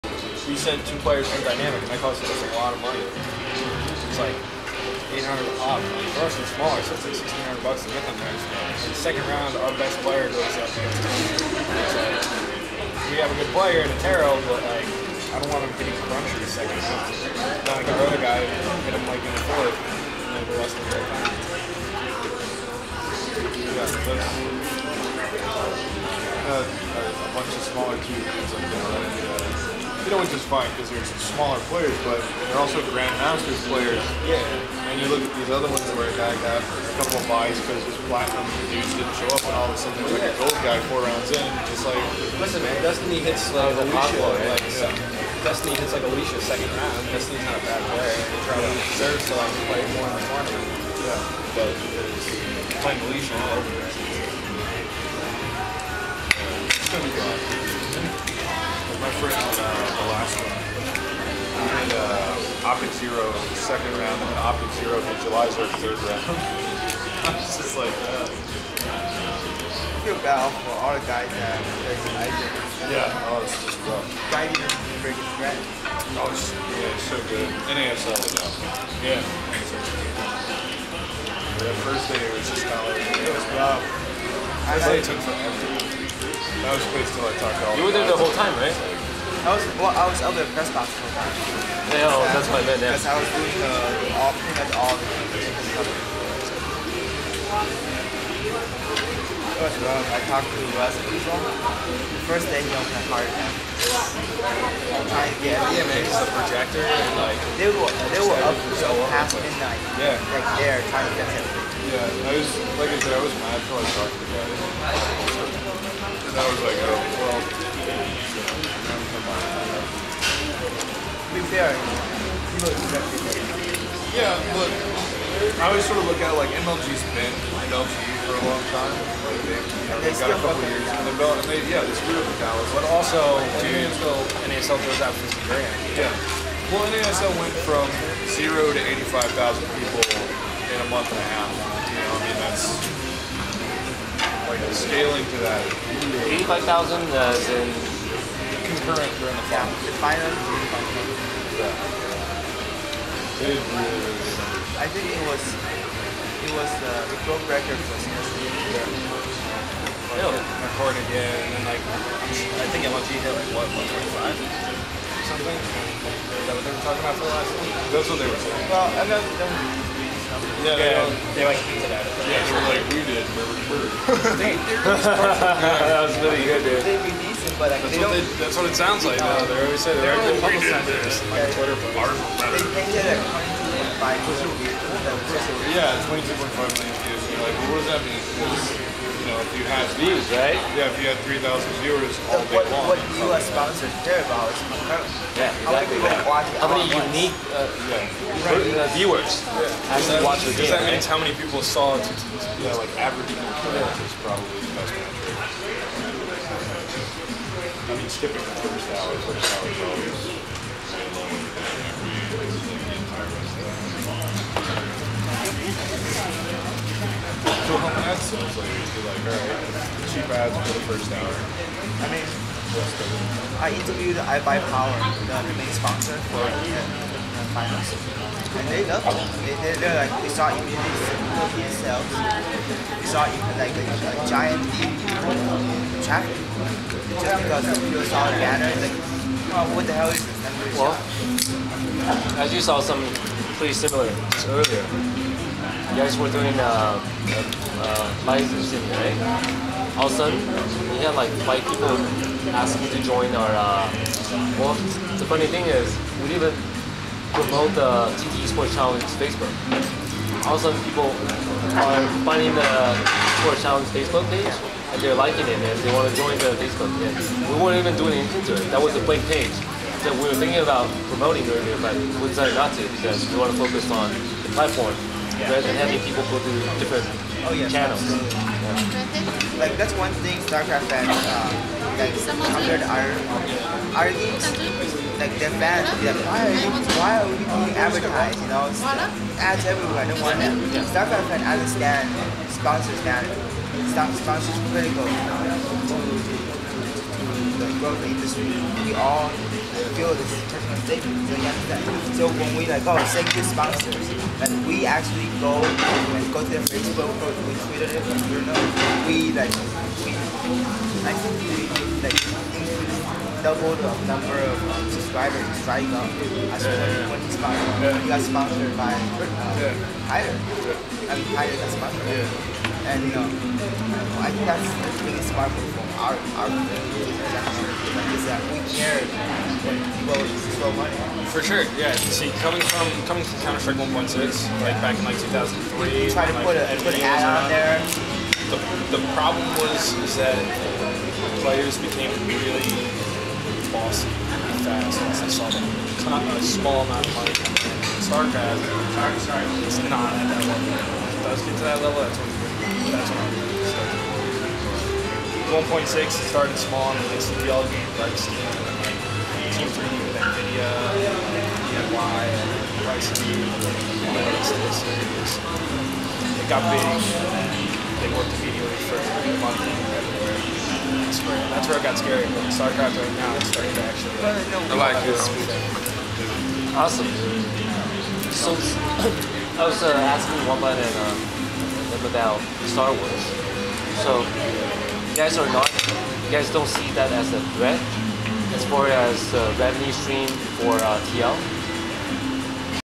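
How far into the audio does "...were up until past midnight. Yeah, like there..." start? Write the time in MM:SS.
01:48.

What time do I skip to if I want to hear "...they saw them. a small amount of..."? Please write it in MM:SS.
05:45.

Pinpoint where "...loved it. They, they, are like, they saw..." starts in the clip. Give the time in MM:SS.
03:48.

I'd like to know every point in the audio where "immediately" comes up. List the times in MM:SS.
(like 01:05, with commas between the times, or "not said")
03:50, 06:08.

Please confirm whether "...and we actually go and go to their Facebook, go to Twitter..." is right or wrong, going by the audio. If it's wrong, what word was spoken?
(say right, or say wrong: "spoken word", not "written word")
right.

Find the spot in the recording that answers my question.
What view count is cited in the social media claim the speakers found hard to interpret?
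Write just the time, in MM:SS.
03:06.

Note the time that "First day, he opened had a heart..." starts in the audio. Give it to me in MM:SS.
01:42.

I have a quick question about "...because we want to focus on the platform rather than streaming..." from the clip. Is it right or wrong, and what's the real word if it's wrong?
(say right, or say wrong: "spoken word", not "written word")
wrong: "having", not "streaming".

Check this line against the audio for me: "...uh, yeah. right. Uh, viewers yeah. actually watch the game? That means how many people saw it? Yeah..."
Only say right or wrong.
right.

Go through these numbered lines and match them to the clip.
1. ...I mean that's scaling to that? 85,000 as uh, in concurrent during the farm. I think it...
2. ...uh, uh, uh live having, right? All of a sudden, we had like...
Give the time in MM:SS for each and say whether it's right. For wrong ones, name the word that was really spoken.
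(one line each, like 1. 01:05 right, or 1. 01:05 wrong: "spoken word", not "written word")
1. 02:22 right
2. 04:06 wrong: "streaming", not "having".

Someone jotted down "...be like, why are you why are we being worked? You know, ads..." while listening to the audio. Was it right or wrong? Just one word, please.
wrong.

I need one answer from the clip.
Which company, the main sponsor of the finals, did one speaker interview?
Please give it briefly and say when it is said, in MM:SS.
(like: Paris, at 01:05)
iBUYPOWER, at 03:44.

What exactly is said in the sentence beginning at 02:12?
But also, NASL, NASL goes out 50 grand.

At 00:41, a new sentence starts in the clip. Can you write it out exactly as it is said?
Just like, listen, man, Destiny hits uh, like Alicia, Pablo, like yeah.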